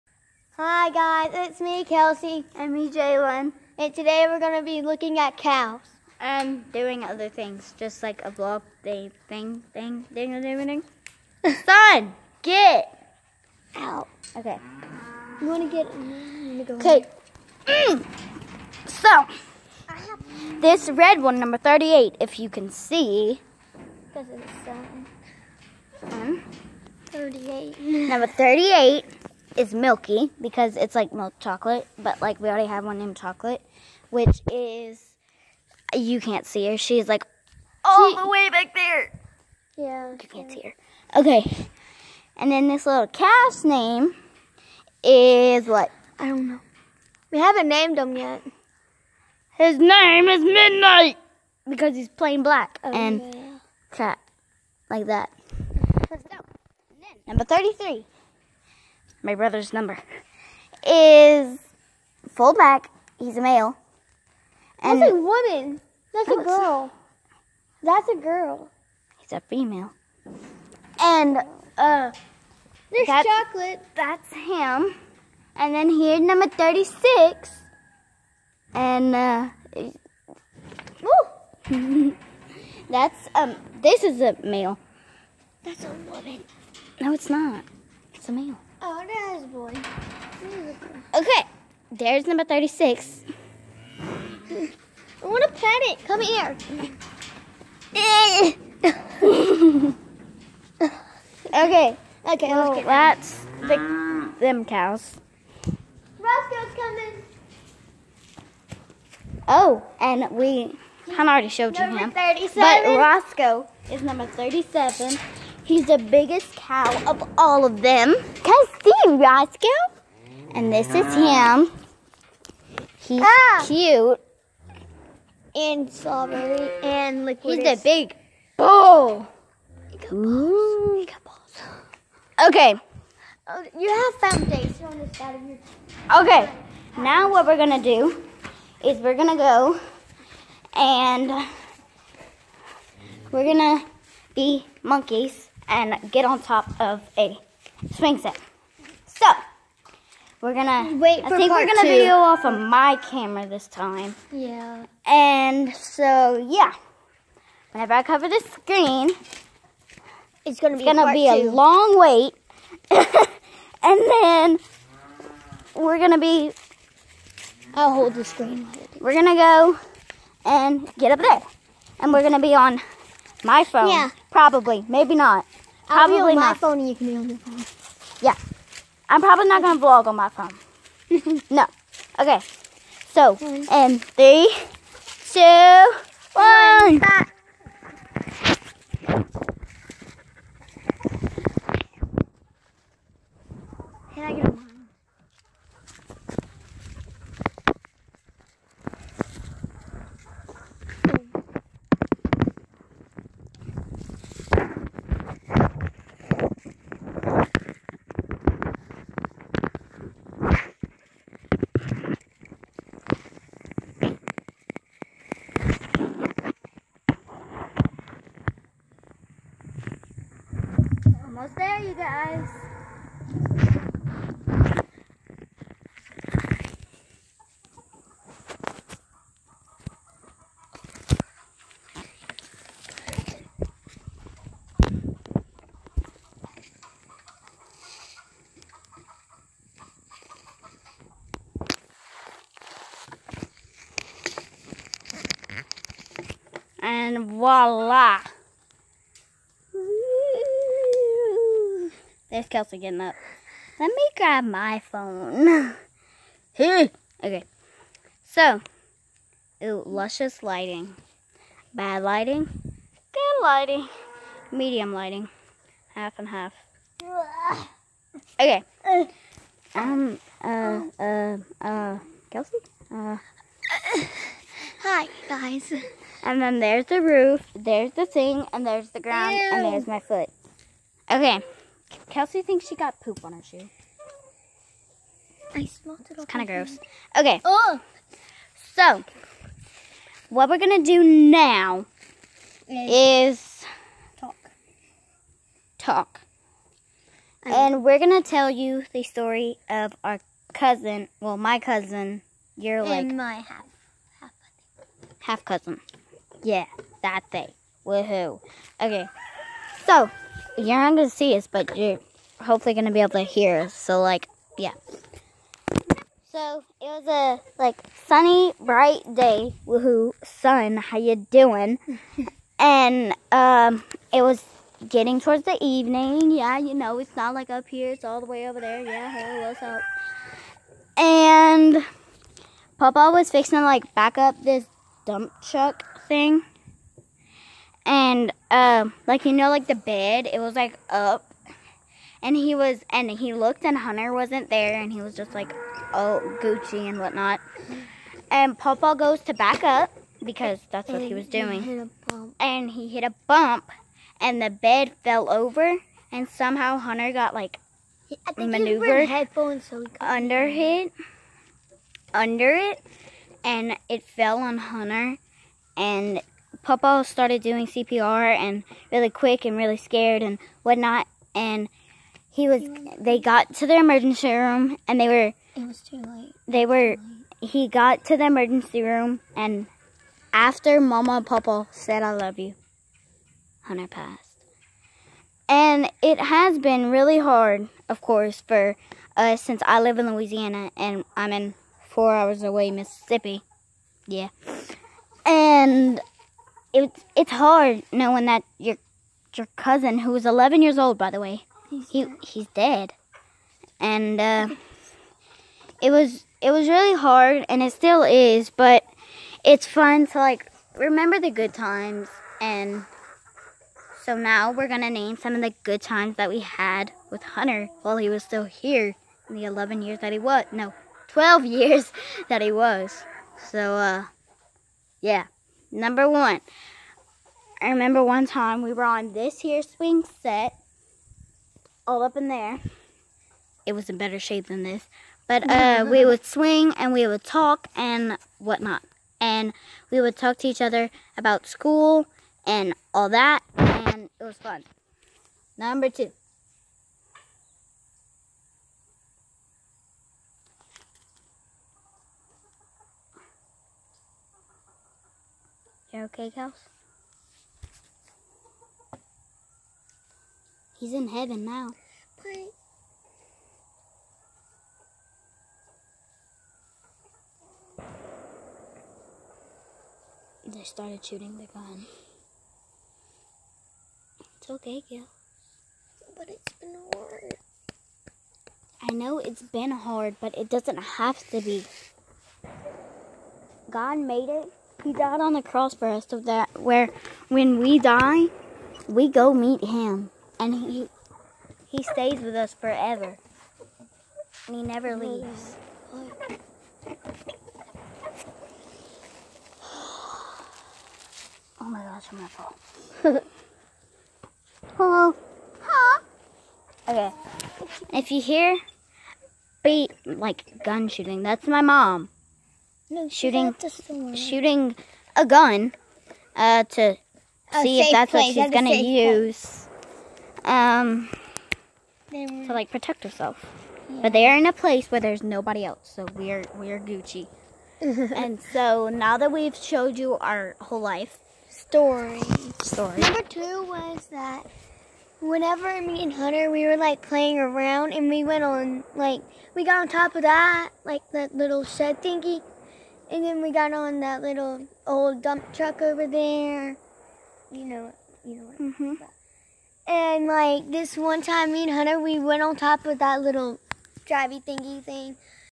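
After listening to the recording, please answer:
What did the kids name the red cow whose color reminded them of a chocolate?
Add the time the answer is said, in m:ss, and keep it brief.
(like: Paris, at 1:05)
Milky, at 0:29.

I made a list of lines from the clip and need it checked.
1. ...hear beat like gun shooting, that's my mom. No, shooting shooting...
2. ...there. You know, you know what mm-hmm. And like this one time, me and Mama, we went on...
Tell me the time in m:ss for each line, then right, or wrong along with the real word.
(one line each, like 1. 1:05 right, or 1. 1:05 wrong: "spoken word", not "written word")
1. 8:28 right
2. 9:06 wrong: "Hunter", not "Mama".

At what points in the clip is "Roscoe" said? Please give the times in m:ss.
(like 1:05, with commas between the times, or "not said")
1:46, 1:52, 1:59.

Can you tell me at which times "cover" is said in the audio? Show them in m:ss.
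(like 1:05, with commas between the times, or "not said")
2:38.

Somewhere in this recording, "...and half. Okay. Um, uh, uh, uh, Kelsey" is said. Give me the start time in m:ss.
4:26.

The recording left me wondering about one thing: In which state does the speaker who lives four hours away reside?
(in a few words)
Louisiana.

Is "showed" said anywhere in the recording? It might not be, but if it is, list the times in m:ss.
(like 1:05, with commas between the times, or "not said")
1:51, 8:49.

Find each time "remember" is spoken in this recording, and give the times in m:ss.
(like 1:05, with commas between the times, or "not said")
6:50, 7:07.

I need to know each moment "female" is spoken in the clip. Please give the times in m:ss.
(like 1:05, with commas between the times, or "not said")
1:09.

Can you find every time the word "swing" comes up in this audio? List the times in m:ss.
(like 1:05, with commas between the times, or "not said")
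2:27, 7:09, 7:16.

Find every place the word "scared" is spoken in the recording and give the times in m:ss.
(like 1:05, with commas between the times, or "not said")
6:09.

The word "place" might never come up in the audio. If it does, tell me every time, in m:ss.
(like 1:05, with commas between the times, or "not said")
8:38, 8:44.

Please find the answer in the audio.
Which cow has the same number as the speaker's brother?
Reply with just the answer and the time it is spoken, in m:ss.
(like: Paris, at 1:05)
33, at 0:57.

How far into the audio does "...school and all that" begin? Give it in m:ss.
7:21.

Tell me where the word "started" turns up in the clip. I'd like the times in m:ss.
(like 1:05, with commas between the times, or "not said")
6:07, 7:50.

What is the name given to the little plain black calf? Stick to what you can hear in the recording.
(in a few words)
Midnight.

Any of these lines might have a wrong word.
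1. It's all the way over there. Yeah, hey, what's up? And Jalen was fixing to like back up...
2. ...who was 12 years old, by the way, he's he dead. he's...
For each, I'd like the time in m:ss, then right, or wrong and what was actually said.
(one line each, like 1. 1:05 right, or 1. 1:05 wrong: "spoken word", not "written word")
1. 5:27 wrong: "Papa", not "Jalen"
2. 6:39 wrong: "11", not "12".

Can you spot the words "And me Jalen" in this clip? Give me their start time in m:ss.
0:02.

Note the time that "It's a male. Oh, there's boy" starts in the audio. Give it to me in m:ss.
1:28.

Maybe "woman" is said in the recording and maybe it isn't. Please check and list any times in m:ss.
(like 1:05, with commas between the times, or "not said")
1:05, 1:26.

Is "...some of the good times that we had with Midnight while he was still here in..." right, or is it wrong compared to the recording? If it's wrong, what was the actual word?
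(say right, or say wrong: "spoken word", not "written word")
wrong: "Hunter", not "Midnight".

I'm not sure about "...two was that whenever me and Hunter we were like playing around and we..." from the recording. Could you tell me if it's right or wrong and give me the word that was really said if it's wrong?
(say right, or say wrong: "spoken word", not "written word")
right.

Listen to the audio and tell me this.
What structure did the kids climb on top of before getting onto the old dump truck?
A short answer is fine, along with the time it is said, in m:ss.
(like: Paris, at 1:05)
Shed, at 9:01.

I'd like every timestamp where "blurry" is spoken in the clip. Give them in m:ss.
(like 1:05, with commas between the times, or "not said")
not said.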